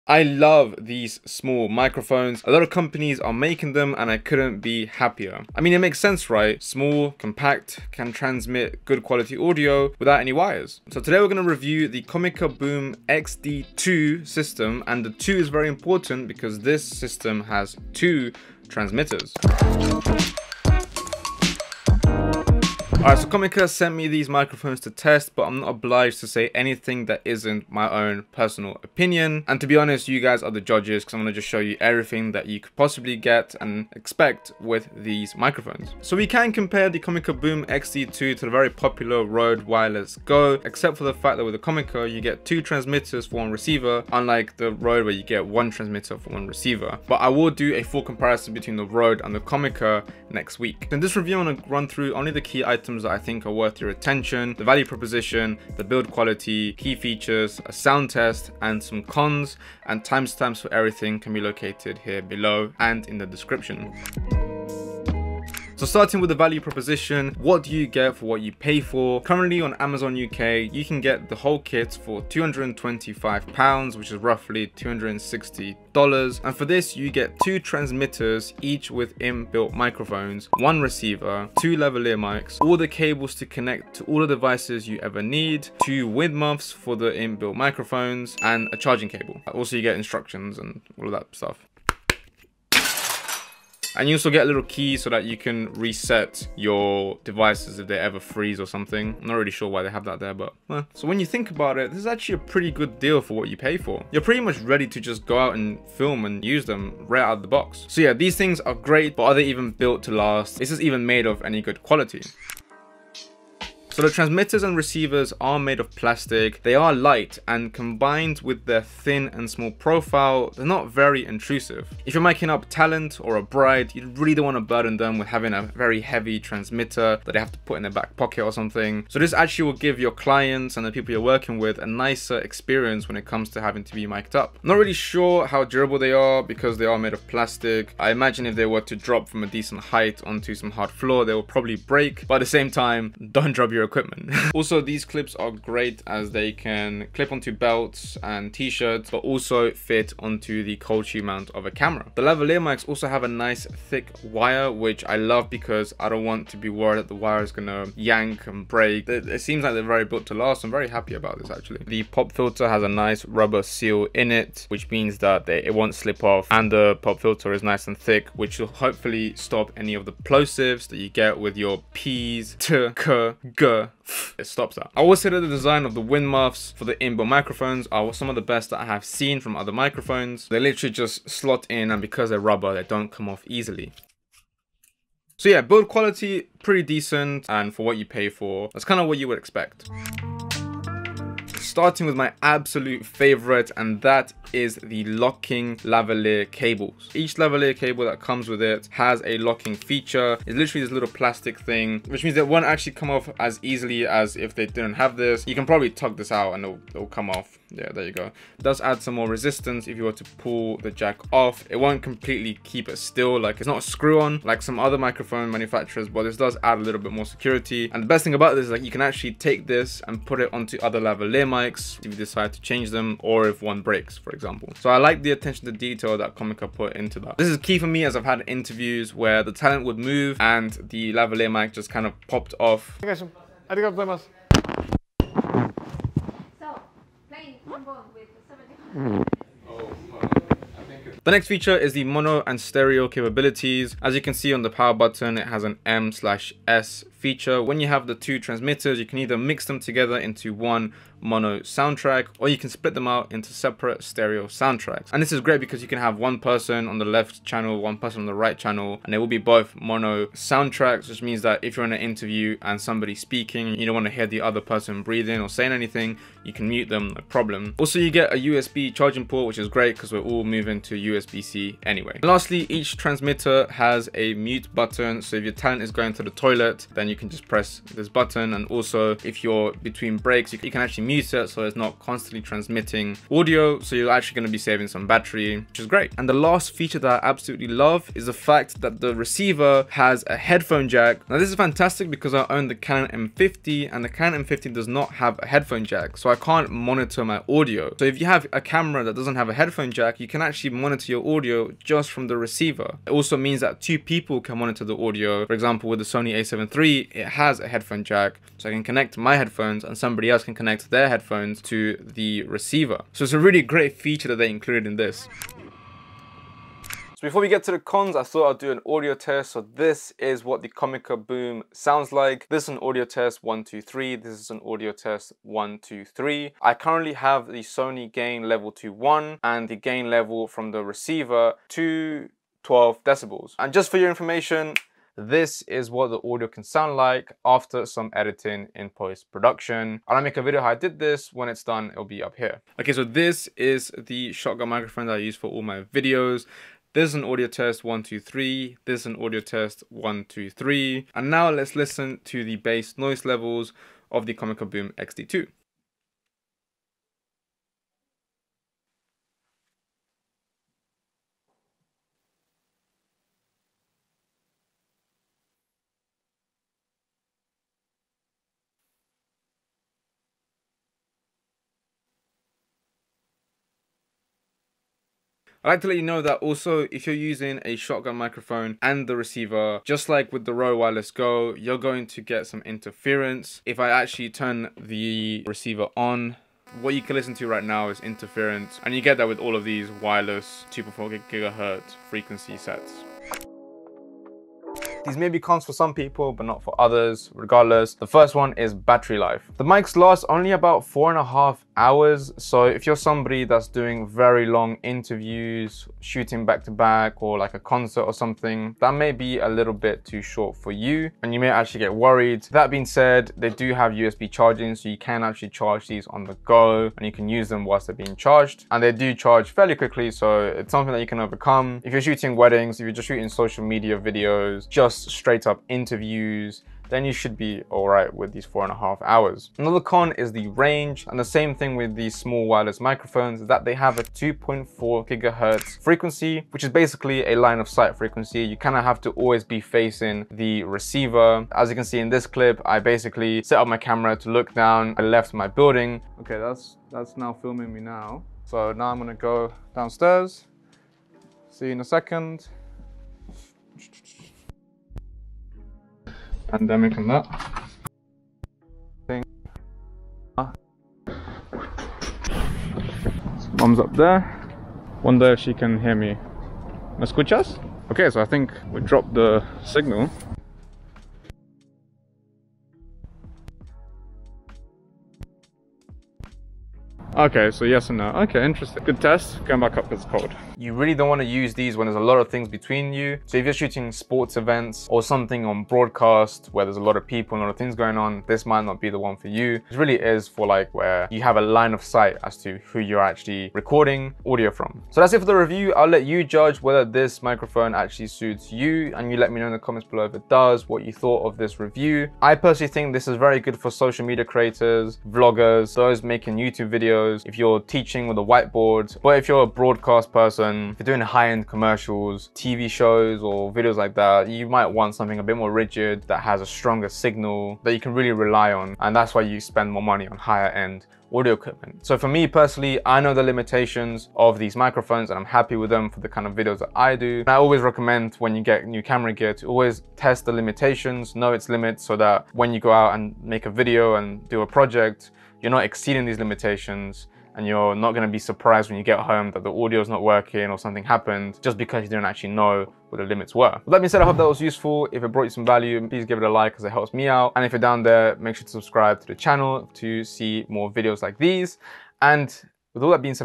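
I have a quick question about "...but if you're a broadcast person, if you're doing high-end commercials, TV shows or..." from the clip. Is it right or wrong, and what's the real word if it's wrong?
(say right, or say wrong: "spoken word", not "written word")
right.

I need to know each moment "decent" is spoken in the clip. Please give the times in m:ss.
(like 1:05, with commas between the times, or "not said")
2:19, 3:06.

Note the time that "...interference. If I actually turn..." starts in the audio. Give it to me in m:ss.
6:22.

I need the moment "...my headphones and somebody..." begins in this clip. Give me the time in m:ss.
5:09.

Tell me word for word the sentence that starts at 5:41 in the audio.
When it's done, it'll be up here.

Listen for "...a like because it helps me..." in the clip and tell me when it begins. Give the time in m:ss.
9:06.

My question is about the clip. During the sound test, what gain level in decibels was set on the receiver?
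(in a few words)
12 decibels.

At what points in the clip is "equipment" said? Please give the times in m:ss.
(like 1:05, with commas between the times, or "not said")
2:23, 8:41.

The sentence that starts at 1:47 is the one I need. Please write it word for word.
So yeah, these things are great, but are they even built to last?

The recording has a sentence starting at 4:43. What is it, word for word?
So you're actually going to be saving some battery, which is great.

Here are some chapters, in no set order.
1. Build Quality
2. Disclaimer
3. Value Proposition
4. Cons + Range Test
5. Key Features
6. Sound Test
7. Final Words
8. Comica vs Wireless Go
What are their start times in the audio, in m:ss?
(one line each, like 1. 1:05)
1. 1:52
2. 0:22
3. 1:04
4. 6:33
5. 3:10
6. 5:16
7. 8:15
8. 0:36.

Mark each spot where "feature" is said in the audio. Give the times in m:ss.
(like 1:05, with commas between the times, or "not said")
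0:56, 3:19, 4:01, 4:07, 4:46, 5:13.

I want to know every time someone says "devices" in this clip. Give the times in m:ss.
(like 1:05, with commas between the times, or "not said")
1:24, 1:37.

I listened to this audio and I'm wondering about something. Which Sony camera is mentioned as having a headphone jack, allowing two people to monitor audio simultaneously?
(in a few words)
Sony a7 III.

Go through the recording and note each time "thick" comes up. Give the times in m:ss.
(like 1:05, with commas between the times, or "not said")
2:33, 2:47.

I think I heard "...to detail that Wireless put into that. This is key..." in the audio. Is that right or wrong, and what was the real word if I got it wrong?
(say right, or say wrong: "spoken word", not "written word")
wrong: "Comica", not "Wireless".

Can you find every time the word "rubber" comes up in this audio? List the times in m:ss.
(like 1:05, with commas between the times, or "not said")
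2:43, 3:02.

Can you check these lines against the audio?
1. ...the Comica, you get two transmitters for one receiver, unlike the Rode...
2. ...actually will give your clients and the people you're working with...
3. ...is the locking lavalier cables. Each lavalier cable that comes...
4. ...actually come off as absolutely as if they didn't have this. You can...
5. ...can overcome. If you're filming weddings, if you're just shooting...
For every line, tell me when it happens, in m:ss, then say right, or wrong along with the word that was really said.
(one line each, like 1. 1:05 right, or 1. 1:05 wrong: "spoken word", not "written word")
1. 0:41 right
2. 2:09 right
3. 3:14 right
4. 3:22 wrong: "easily", not "absolutely"
5. 7:01 wrong: "shooting", not "filming".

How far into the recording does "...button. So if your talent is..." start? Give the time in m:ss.
4:34.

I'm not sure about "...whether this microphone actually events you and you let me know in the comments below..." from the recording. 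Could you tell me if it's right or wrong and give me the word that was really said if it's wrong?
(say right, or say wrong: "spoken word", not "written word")
wrong: "suits", not "events".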